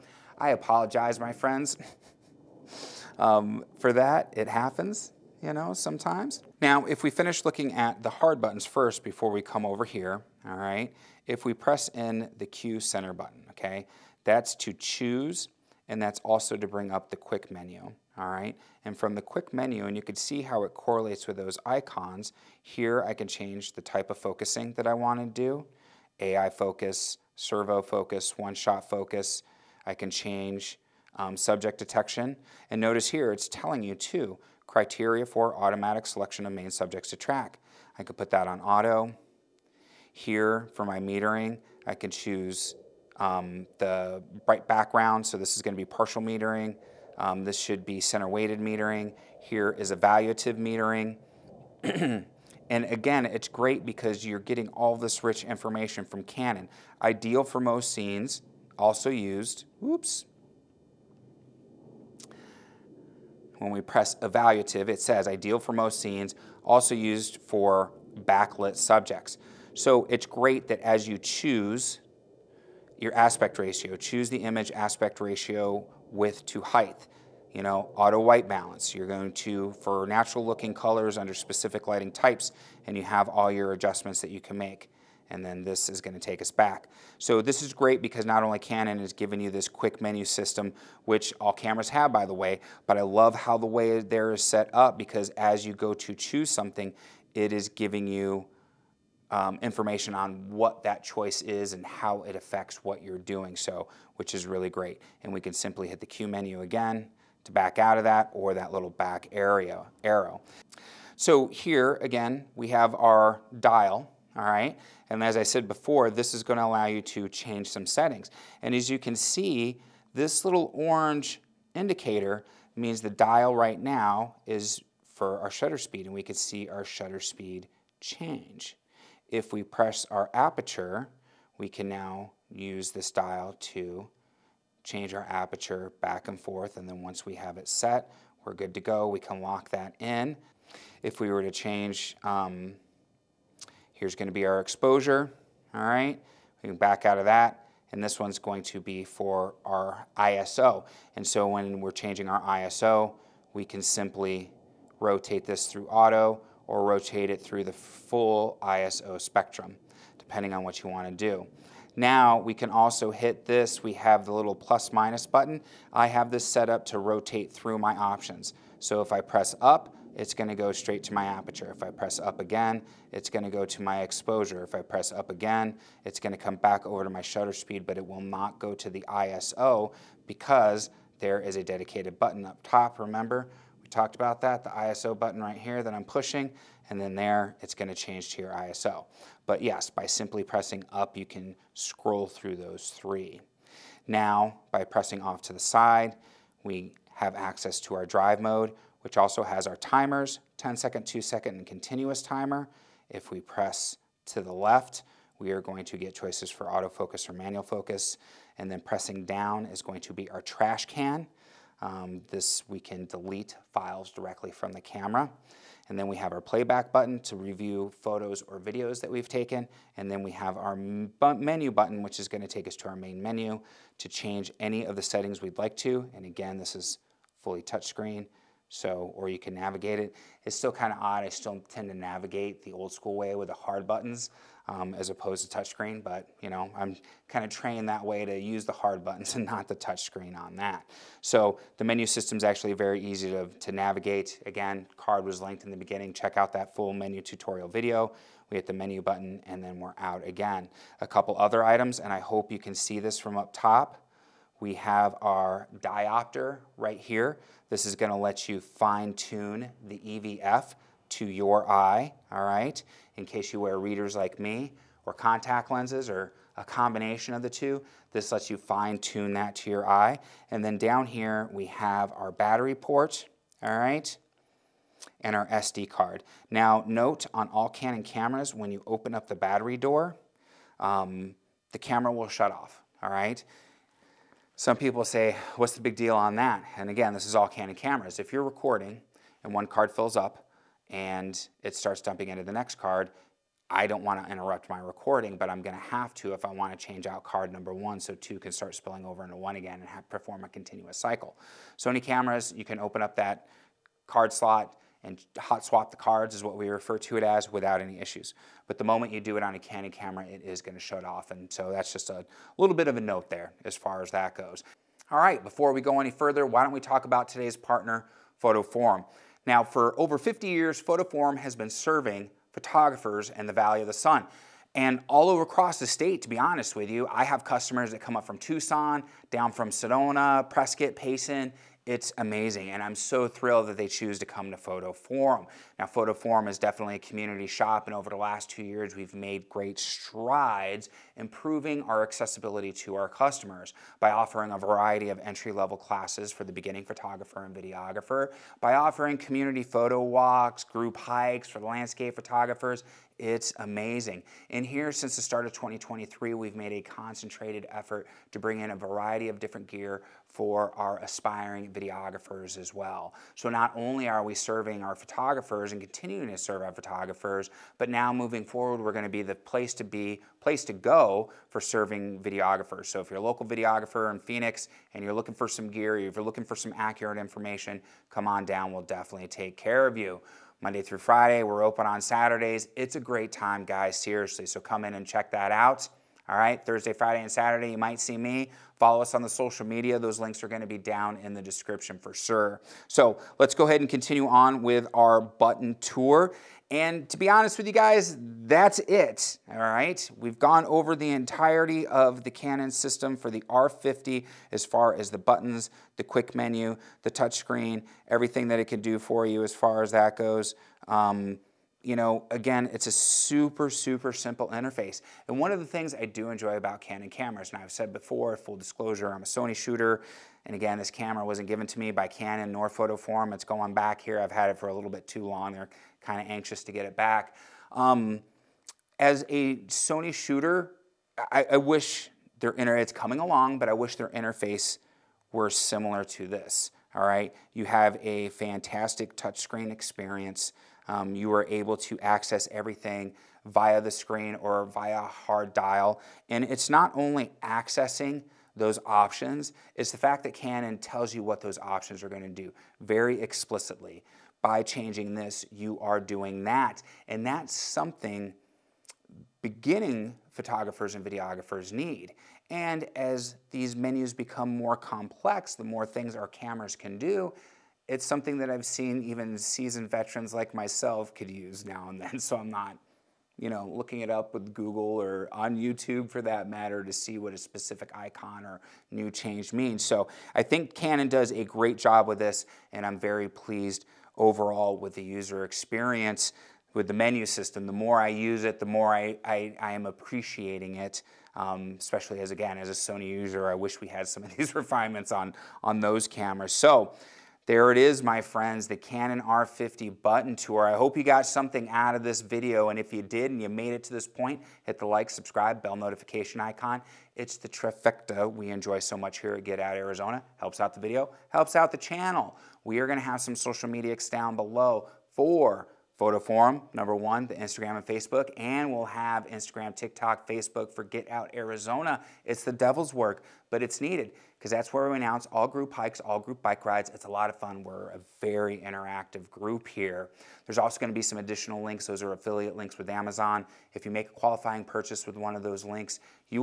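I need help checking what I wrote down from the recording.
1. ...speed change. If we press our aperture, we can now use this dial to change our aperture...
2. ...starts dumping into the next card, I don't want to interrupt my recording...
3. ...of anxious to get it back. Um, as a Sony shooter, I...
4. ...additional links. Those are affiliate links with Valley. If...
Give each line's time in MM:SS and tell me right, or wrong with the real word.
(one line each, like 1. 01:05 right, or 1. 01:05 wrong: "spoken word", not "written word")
1. 02:07 right
2. 04:51 right
3. 07:06 right
4. 08:51 wrong: "Amazon", not "Valley".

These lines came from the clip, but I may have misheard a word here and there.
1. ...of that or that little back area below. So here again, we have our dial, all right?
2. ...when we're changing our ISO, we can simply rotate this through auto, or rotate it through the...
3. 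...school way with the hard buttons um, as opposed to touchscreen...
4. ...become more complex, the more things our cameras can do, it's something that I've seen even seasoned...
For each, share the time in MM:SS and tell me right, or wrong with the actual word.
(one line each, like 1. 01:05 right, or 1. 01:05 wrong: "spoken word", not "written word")
1. 01:47 wrong: "arrow", not "below"
2. 02:31 right
3. 03:52 right
4. 07:44 right.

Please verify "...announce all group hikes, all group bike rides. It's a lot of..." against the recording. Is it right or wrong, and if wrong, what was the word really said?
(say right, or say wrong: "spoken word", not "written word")
right.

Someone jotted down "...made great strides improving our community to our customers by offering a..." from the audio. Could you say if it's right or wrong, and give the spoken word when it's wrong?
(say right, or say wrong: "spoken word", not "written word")
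wrong: "accessibility", not "community".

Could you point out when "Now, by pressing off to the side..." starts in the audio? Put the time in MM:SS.
03:14.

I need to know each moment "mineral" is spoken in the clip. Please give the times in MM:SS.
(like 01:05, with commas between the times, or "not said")
not said.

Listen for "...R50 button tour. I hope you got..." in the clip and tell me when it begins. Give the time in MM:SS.
08:19.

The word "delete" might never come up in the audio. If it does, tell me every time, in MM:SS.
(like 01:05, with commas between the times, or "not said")
03:33.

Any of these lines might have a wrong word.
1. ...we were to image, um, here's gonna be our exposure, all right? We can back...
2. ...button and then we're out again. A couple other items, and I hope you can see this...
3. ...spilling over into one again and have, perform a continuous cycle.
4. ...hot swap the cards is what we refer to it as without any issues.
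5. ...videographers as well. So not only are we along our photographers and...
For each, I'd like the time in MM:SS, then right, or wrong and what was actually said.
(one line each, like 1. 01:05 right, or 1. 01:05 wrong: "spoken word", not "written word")
1. 02:21 wrong: "change", not "image"
2. 04:09 right
3. 04:58 right
4. 05:05 right
5. 06:01 wrong: "serving", not "along".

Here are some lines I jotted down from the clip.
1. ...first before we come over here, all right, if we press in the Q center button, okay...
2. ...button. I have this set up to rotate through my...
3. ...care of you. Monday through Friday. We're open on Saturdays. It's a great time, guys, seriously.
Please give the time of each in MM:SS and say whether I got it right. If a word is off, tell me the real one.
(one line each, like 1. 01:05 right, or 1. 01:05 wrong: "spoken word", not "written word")
1. 00:08 right
2. 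02:45 right
3. 06:19 right.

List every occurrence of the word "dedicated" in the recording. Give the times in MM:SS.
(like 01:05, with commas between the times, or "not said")
03:01.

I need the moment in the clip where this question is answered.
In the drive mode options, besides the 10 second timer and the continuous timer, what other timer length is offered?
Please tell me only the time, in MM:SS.
03:21.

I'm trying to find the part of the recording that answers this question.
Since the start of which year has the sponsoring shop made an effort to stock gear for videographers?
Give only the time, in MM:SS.
05:55.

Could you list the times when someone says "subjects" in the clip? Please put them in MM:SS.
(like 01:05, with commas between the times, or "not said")
00:31, 00:36, 01:08.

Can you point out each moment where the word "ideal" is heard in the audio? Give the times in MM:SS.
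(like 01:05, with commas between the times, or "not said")
00:57, 01:05.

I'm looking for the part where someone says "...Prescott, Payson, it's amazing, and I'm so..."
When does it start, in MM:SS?
05:30.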